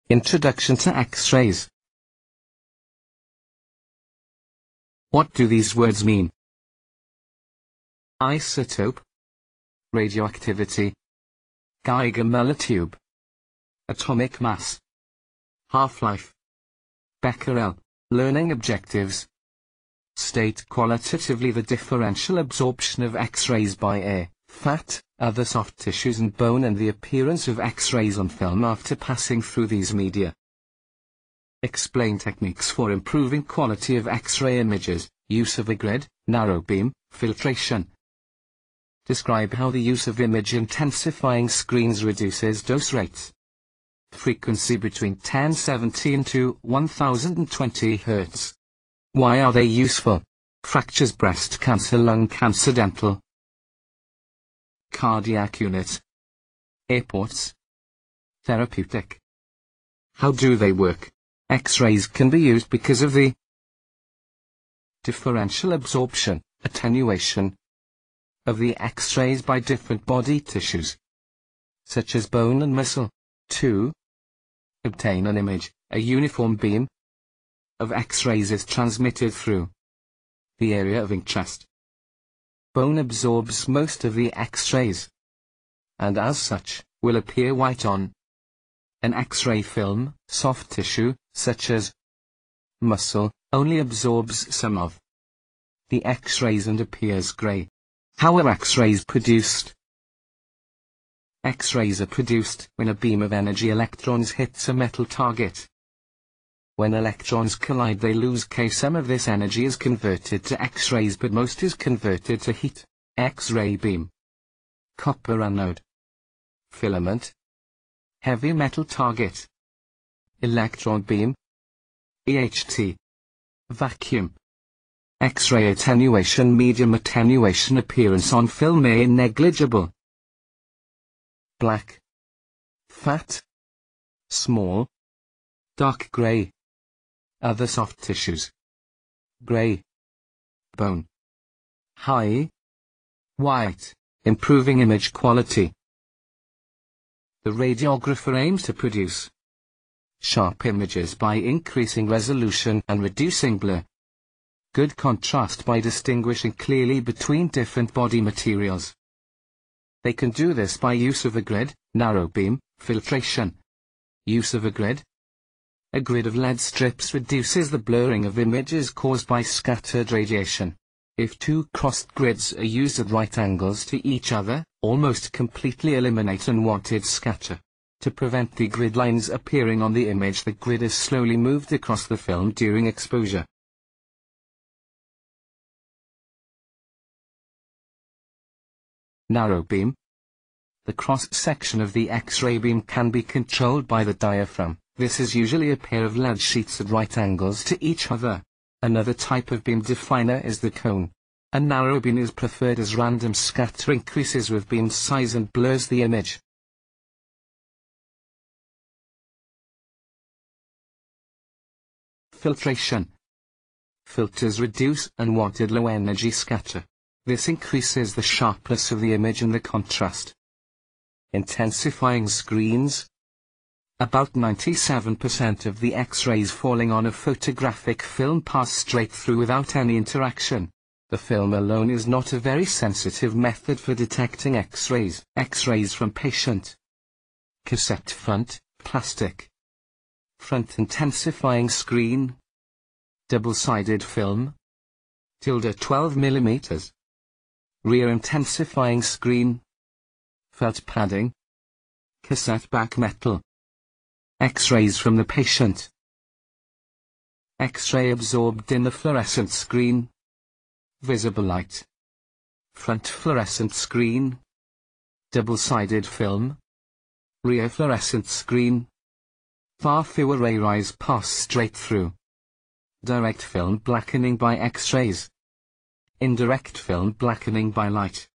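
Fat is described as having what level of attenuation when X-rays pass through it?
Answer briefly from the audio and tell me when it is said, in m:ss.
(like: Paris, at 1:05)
Small, at 2:14.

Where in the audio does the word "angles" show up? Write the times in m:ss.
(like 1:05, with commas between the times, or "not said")
2:53, 3:17.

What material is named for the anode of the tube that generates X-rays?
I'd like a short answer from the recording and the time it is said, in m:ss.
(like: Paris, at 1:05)
Copper, at 1:54.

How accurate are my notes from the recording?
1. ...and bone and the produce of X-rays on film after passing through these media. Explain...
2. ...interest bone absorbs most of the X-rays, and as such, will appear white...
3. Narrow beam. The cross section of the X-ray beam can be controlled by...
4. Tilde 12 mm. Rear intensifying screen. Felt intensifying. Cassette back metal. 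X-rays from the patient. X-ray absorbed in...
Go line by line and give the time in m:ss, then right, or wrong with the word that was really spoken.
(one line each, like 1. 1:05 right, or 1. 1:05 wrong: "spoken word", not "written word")
1. 0:26 wrong: "appearance", not "produce"
2. 1:21 right
3. 3:09 right
4. 4:05 wrong: "padding", not "intensifying".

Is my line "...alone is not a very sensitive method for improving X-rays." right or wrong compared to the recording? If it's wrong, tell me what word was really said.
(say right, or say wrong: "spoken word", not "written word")
wrong: "detecting", not "improving".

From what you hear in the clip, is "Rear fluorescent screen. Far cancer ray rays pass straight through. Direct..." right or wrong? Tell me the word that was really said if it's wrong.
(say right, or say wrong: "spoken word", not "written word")
wrong: "fewer", not "cancer".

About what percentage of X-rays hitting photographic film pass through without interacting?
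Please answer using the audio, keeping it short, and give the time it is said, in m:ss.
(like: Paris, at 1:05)
97%, at 3:44.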